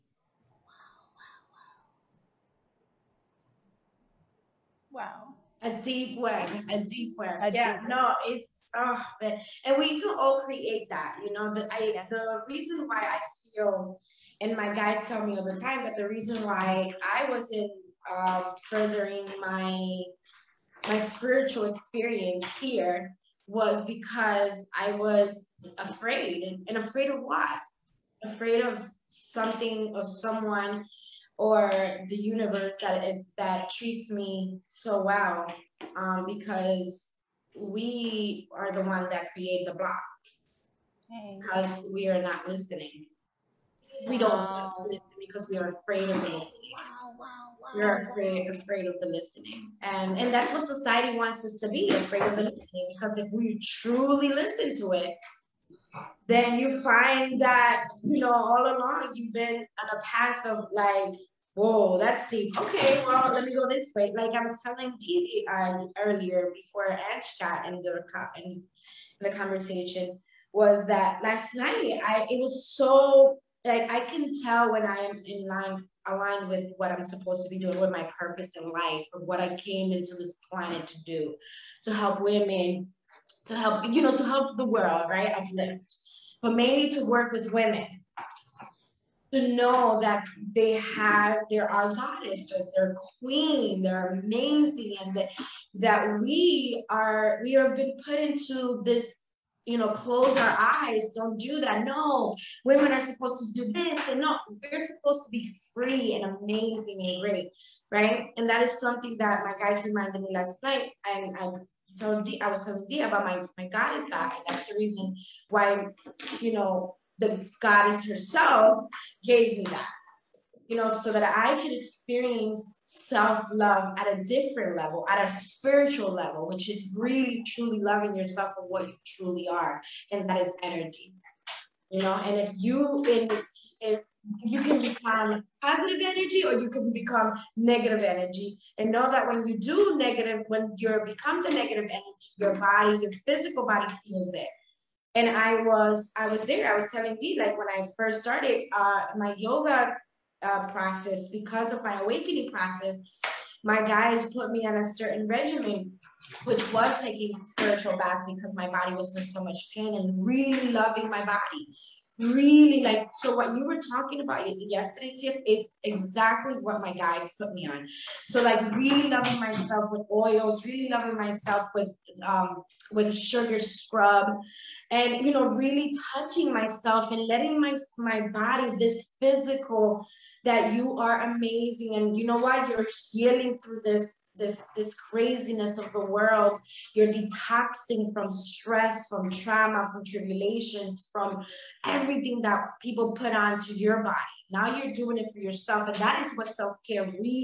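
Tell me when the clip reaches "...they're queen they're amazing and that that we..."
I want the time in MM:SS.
01:32.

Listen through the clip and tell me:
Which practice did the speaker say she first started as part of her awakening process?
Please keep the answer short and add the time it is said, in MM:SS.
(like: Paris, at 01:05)
Yoga, at 02:29.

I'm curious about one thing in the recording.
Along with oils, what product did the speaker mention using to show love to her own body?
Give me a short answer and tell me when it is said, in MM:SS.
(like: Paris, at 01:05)
Sugar scrub, at 02:53.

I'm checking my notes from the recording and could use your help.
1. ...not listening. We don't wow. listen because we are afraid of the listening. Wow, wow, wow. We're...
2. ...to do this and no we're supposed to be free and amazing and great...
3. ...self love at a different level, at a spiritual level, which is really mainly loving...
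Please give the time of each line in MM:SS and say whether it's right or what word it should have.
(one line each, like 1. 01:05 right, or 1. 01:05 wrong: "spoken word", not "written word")
1. 00:42 right
2. 01:43 right
3. 02:02 wrong: "truly", not "mainly".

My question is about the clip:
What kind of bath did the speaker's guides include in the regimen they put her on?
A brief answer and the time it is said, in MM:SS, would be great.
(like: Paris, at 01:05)
Spiritual bath, at 02:37.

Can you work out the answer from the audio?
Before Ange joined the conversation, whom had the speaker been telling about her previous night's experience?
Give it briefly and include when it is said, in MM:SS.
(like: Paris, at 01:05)
TV, at 01:04.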